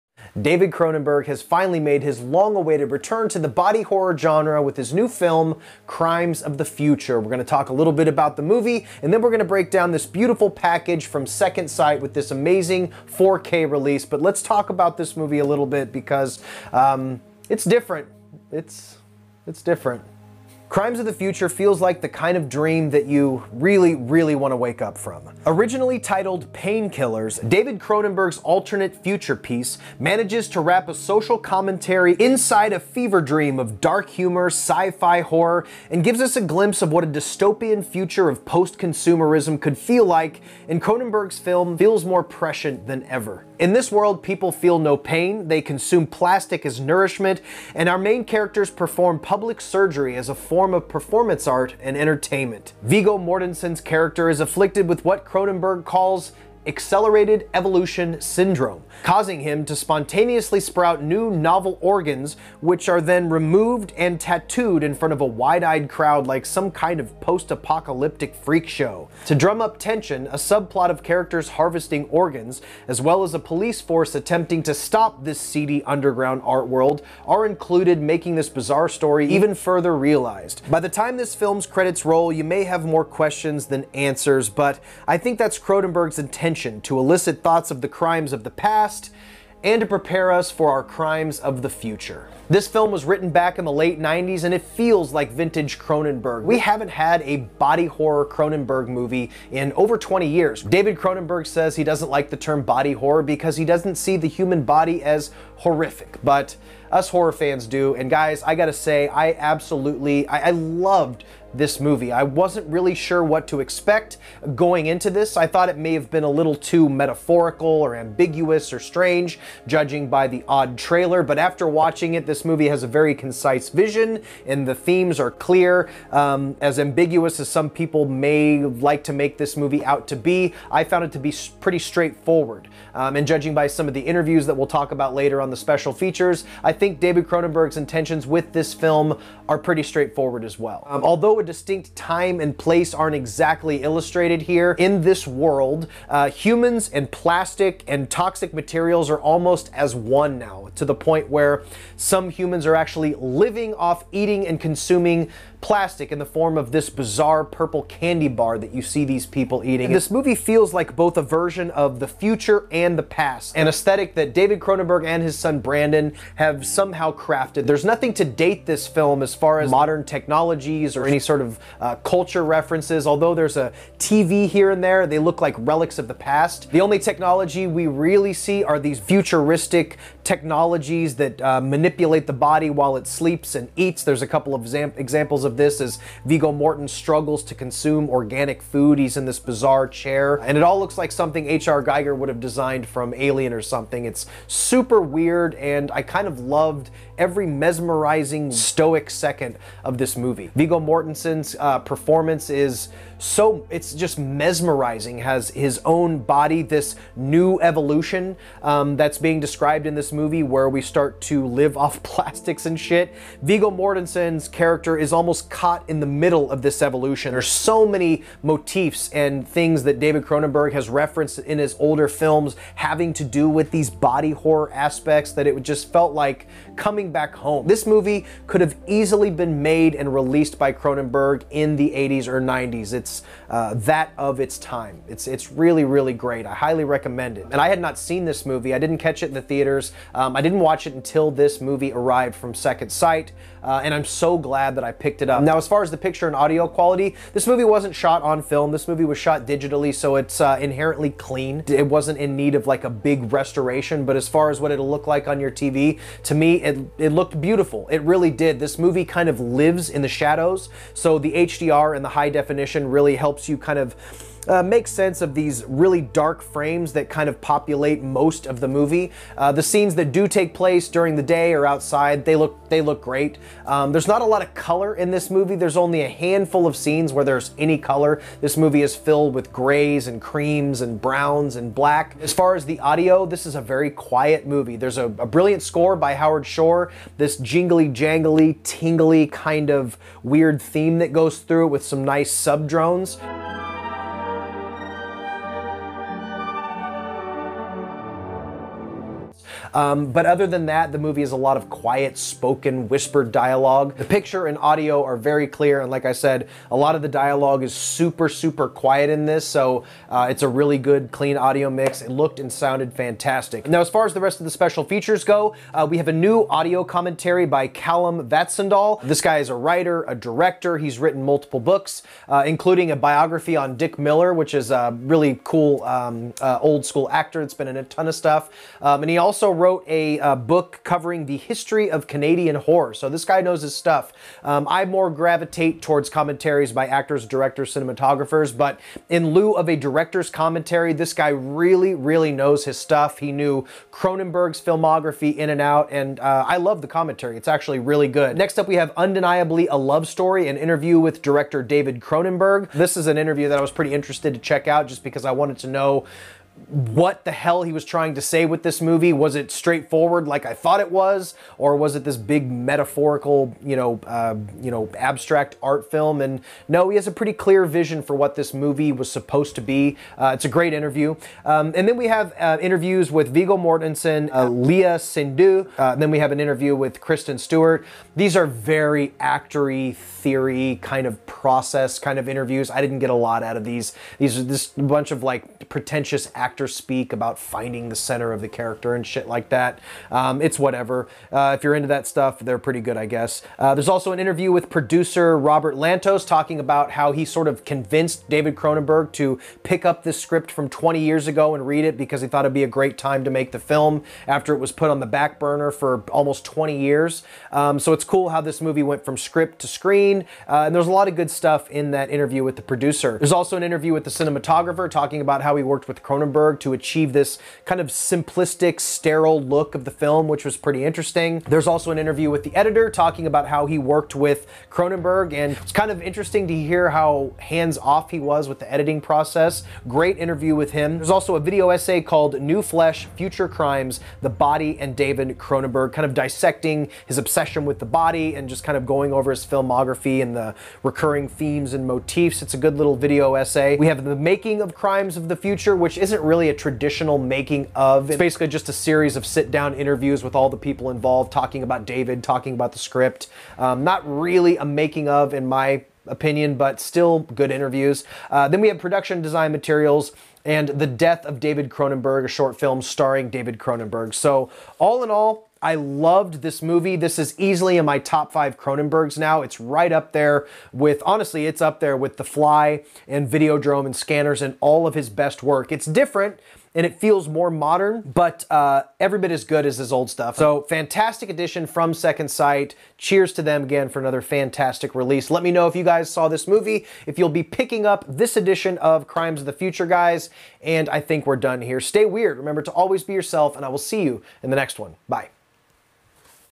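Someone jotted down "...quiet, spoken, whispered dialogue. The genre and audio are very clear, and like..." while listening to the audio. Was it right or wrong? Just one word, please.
wrong.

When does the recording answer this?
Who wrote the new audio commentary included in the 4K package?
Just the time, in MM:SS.
05:17.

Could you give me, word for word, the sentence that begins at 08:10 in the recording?
And I think we're done here.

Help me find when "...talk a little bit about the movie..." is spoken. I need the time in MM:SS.
00:07.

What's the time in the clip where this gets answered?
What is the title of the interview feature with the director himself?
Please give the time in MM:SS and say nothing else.
05:48.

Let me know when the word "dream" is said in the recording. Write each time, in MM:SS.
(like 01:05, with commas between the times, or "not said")
00:22, 00:33.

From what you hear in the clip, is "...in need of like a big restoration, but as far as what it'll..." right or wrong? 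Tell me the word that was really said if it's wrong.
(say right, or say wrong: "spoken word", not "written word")
right.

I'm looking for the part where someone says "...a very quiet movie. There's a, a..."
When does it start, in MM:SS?
04:43.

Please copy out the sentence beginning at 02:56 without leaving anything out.
The only technology we really see are these futuristic technologies that uh, manipulate the body while it sleeps and eats.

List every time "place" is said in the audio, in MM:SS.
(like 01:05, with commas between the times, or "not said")
02:22, 04:30.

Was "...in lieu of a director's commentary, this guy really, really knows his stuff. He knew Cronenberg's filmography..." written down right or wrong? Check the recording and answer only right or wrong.
right.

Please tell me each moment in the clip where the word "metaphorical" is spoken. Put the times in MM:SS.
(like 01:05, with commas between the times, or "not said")
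01:56, 06:02.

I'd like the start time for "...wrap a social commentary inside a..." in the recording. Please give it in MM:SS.
00:30.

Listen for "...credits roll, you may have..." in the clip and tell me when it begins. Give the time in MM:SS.
01:21.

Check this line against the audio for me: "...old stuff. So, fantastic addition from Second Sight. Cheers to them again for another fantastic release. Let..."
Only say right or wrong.
right.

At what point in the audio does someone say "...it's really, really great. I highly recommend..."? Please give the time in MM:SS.
03:55.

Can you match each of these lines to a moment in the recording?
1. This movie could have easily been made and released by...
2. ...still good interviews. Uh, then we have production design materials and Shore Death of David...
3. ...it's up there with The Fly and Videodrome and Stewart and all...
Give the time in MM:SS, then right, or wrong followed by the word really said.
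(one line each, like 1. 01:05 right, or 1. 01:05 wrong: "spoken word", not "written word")
1. 03:47 right
2. 07:36 wrong: "The", not "Shore"
3. 07:51 wrong: "Scanners", not "Stewart".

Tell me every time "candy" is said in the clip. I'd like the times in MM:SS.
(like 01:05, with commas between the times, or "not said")
02:37.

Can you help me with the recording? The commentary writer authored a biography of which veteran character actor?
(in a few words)
Dick Miller.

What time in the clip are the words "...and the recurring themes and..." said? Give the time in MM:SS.
07:20.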